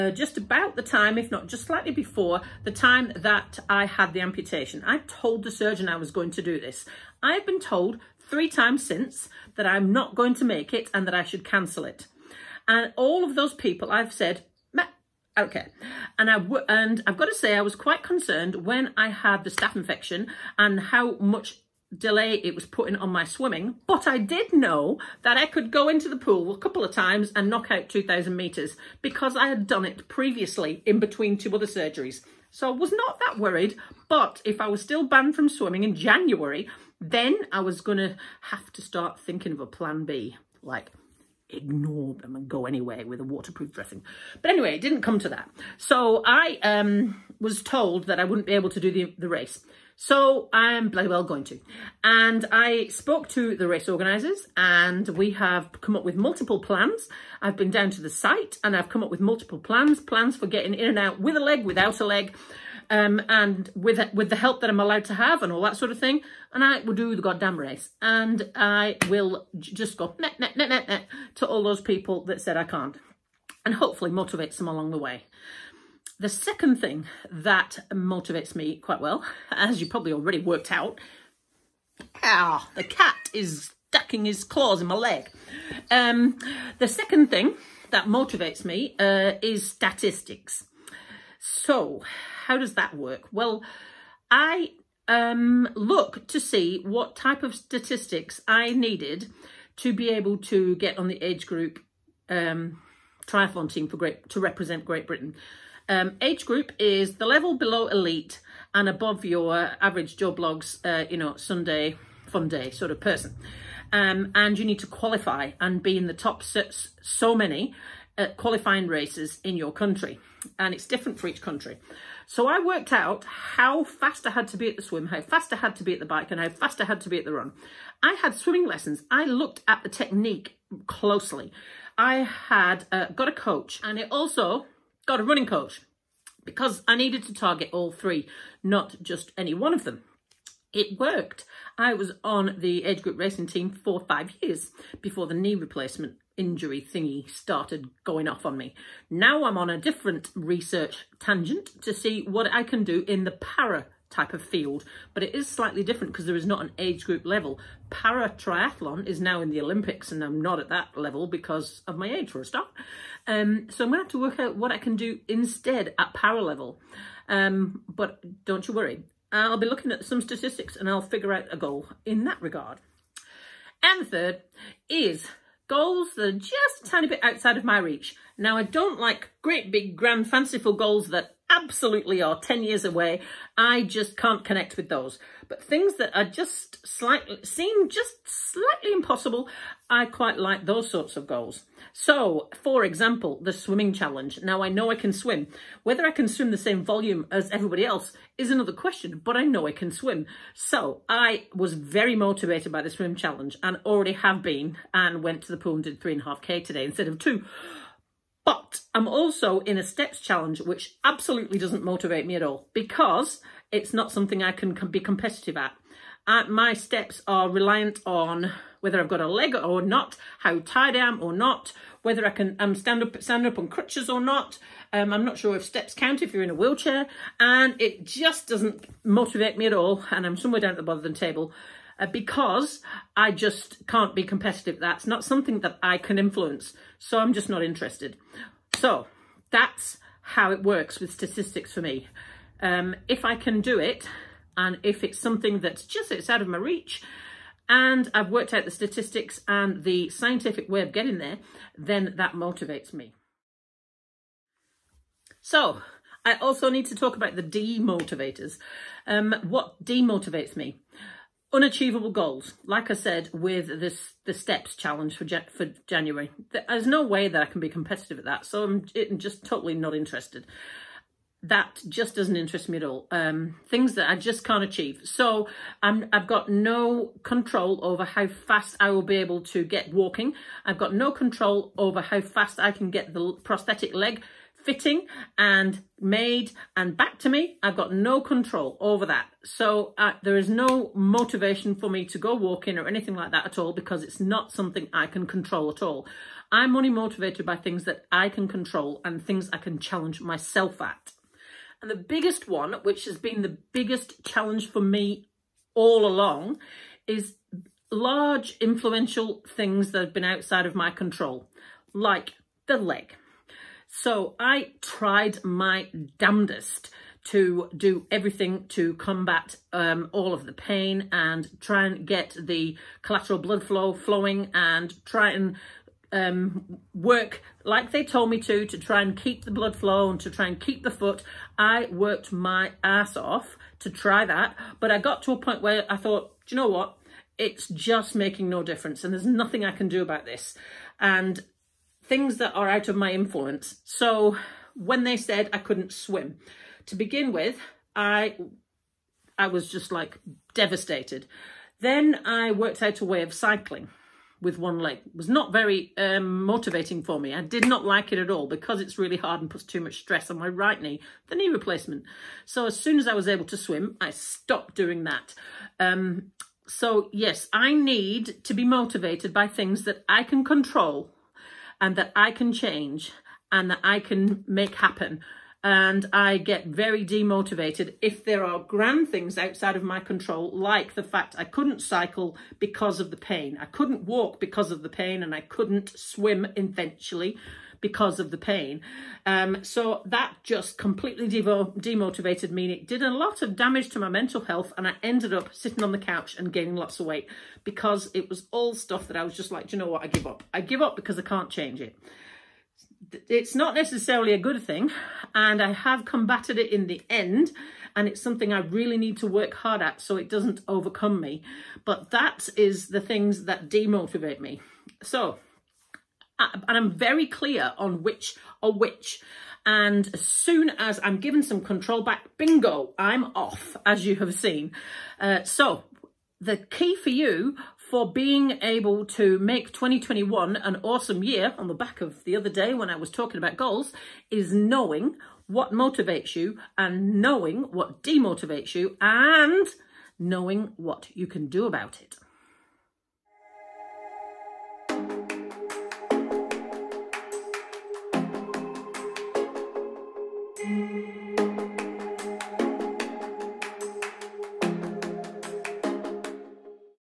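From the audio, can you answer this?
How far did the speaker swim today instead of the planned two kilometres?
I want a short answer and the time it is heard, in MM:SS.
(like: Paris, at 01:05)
3.5 km, at 03:26.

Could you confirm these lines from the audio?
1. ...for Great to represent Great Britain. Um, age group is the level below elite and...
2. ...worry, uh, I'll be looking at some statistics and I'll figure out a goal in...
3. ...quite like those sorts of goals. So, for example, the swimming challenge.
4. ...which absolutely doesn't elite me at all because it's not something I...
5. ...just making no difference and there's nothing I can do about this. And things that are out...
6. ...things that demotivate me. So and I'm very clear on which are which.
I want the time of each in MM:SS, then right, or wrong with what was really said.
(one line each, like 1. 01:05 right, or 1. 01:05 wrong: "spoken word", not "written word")
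1. 01:43 right
2. 02:48 right
3. 03:10 right
4. 03:30 wrong: "motivate", not "elite"
5. 05:37 right
6. 06:53 right.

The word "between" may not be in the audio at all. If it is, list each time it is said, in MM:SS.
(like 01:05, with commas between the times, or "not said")
00:30.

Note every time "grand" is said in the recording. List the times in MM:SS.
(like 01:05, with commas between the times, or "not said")
02:59, 06:18.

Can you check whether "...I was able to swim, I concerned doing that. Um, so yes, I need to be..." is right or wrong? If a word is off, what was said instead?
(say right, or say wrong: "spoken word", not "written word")
wrong: "stopped", not "concerned".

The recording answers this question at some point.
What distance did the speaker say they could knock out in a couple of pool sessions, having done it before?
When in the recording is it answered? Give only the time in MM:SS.
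00:27.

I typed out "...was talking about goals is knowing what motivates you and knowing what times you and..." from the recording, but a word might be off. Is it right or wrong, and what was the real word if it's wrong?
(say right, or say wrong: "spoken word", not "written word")
wrong: "demotivates", not "times".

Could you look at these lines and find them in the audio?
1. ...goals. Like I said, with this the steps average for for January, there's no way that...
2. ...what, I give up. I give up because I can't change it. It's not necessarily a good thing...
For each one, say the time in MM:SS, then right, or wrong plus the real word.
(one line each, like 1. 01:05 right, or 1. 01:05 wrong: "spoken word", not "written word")
1. 04:22 wrong: "challenge", not "average"
2. 06:39 right.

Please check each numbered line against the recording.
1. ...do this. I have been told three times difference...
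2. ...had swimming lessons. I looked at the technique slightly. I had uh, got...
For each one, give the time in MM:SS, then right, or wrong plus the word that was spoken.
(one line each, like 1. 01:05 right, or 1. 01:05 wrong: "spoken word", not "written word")
1. 00:06 wrong: "since", not "difference"
2. 02:08 wrong: "closely", not "slightly".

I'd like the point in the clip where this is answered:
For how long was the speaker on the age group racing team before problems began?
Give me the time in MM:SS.
02:24.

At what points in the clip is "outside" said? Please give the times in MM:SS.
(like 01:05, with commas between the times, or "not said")
02:57, 05:10, 06:19.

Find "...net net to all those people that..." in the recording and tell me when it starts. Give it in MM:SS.
01:10.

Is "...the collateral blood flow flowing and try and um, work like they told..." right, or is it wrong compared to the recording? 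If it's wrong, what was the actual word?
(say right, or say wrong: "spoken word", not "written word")
right.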